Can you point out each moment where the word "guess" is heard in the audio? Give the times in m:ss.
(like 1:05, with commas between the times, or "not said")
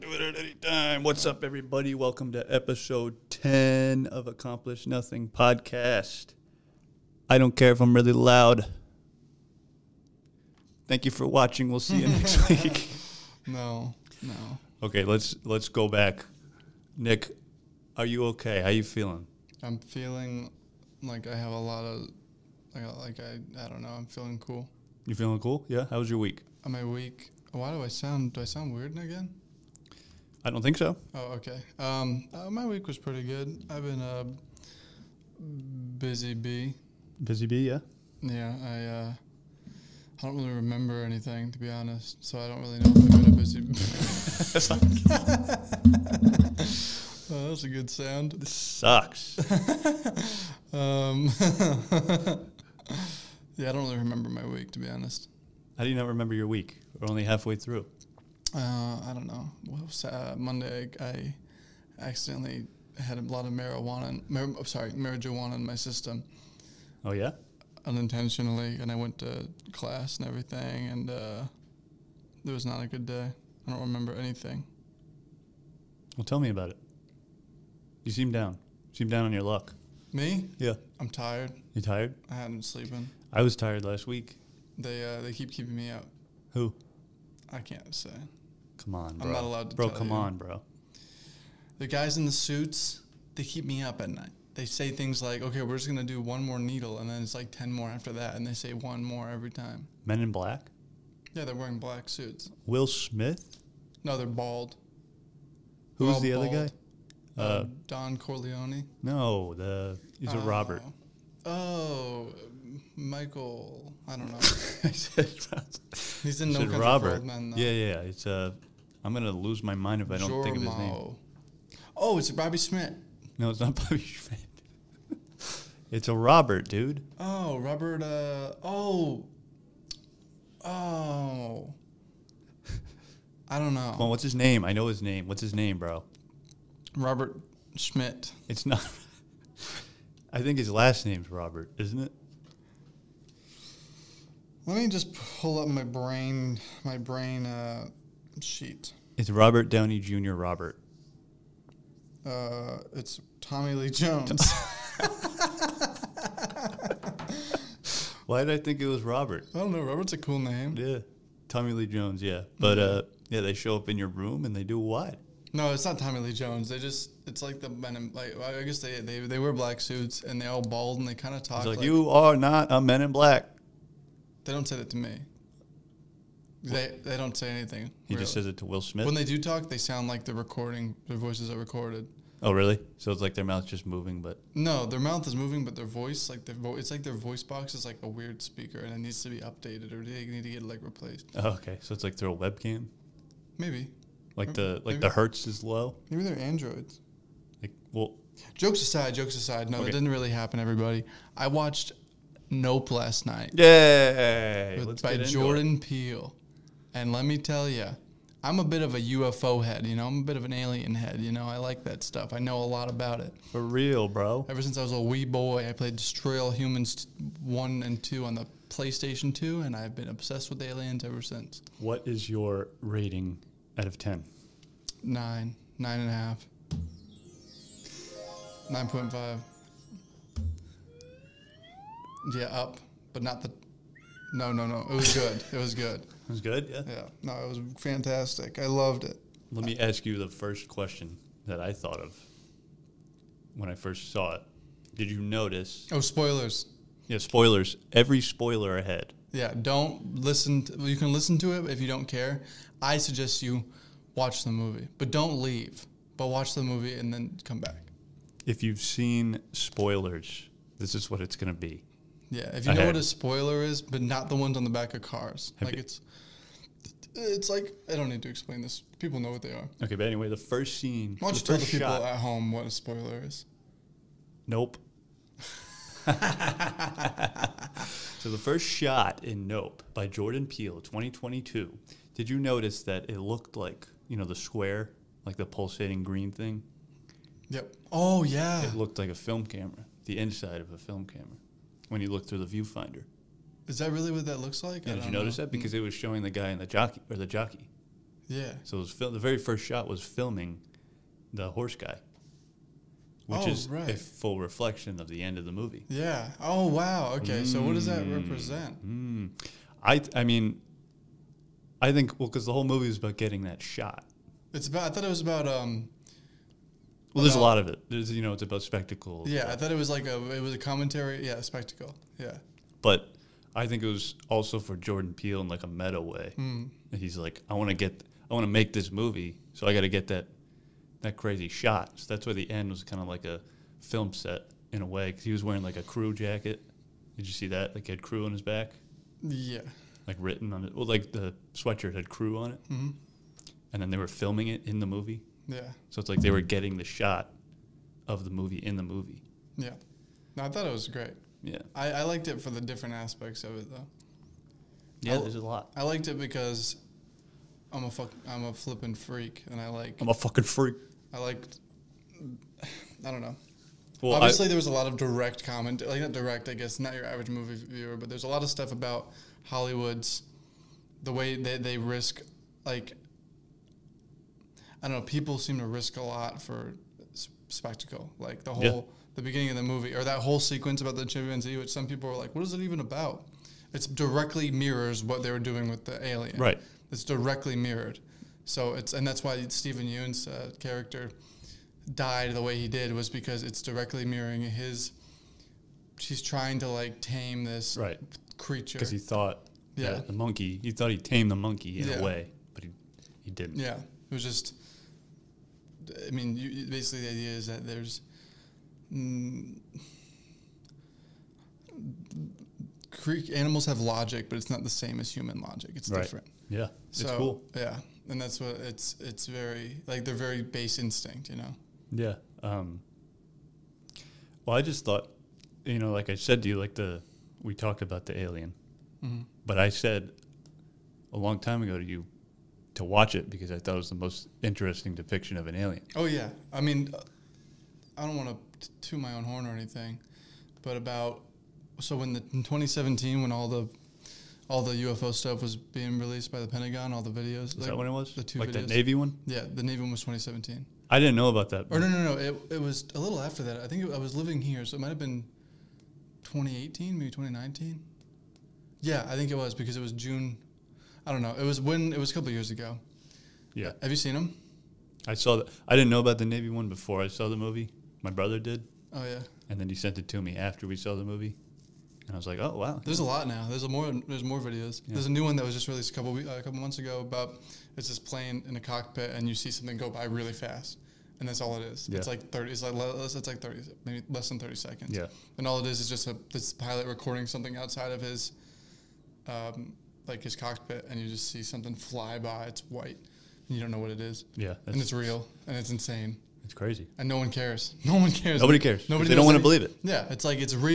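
2:48, 6:06.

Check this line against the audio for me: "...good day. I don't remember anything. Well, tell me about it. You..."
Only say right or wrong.
right.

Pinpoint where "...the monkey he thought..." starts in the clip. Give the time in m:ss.
6:40.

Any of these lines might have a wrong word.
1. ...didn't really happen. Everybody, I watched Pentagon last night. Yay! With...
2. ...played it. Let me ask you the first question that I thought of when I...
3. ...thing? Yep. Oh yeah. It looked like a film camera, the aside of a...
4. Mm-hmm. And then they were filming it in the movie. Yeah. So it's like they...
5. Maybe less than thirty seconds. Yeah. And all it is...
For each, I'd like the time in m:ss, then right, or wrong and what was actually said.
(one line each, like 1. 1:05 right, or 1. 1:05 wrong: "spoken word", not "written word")
1. 3:19 wrong: "Nope", not "Pentagon"
2. 3:58 wrong: "loved", not "played"
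3. 4:46 wrong: "inside", not "aside"
4. 5:42 right
5. 8:03 right.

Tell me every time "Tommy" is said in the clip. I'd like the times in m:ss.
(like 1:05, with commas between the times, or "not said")
2:33, 2:41, 2:45.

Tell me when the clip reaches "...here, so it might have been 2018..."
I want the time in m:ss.
7:34.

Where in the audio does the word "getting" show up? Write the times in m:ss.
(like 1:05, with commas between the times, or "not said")
5:13, 5:46.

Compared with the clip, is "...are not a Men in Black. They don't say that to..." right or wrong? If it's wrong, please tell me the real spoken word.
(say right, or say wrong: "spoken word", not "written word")
right.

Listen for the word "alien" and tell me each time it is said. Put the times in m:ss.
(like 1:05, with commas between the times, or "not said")
3:30, 3:40, 6:26, 7:08, 7:15.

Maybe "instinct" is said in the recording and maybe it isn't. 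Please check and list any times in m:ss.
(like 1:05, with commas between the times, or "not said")
7:00.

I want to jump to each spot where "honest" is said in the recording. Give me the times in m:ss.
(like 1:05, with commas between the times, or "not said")
0:41, 0:54.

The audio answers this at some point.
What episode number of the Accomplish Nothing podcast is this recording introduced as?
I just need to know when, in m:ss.
0:02.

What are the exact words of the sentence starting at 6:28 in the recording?
So it's and that's why Steven Yeun's uh, character died the way he did was because it's directly mirroring his.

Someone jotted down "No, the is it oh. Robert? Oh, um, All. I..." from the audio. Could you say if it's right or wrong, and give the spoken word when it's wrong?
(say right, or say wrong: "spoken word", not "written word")
wrong: "Michael", not "All".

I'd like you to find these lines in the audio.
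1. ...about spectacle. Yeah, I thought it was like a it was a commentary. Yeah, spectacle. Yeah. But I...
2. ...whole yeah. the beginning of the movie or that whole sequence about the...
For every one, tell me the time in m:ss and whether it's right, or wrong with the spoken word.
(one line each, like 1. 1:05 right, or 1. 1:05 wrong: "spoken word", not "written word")
1. 5:18 right
2. 6:18 right.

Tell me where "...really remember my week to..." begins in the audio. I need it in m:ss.
0:53.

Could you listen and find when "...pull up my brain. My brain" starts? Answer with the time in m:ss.
2:25.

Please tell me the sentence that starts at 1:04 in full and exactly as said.
Mar- oh, sorry, marijuana in my system.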